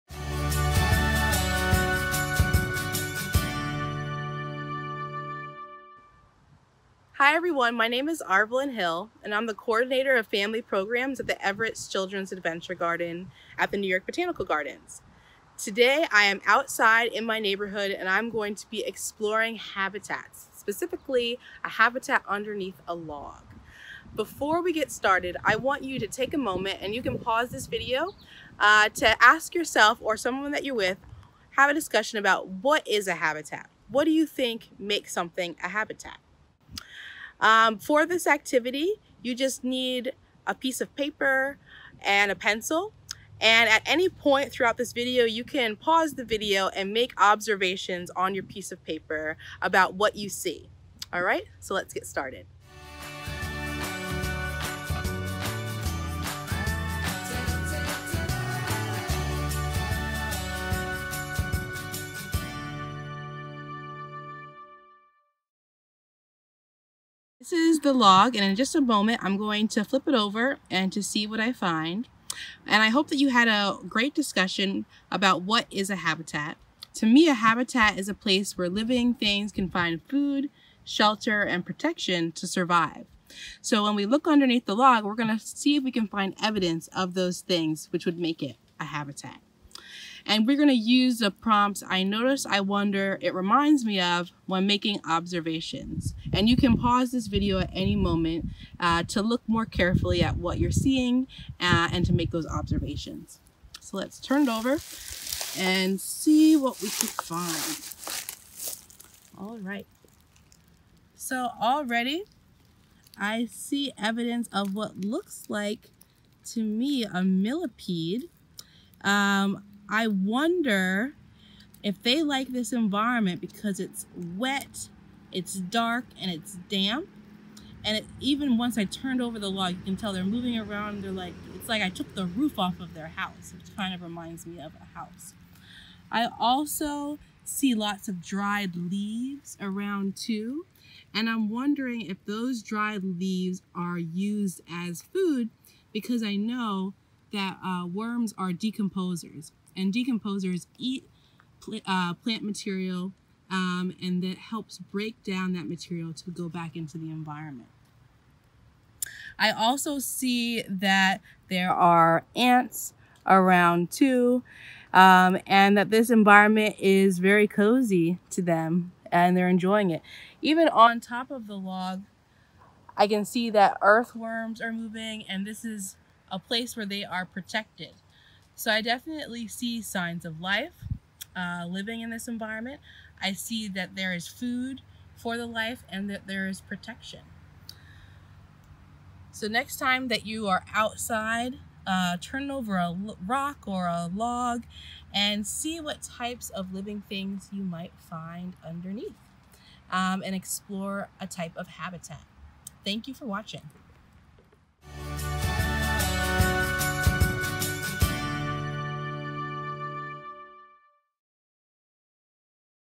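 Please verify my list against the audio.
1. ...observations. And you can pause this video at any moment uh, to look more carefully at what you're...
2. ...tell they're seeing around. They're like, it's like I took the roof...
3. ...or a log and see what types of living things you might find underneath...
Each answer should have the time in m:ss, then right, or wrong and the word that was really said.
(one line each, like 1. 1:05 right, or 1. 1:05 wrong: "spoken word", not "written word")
1. 1:35 right
2. 2:09 wrong: "moving", not "seeing"
3. 3:13 right.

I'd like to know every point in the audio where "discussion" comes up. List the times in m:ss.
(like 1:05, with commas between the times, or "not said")
0:31, 1:14.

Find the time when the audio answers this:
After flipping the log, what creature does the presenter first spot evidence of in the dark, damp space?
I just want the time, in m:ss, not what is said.
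1:57.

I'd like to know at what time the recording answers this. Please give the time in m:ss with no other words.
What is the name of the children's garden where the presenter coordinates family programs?
0:11.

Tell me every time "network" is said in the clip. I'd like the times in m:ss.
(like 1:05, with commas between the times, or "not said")
not said.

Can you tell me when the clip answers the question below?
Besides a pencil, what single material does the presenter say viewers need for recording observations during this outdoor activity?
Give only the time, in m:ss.
0:40.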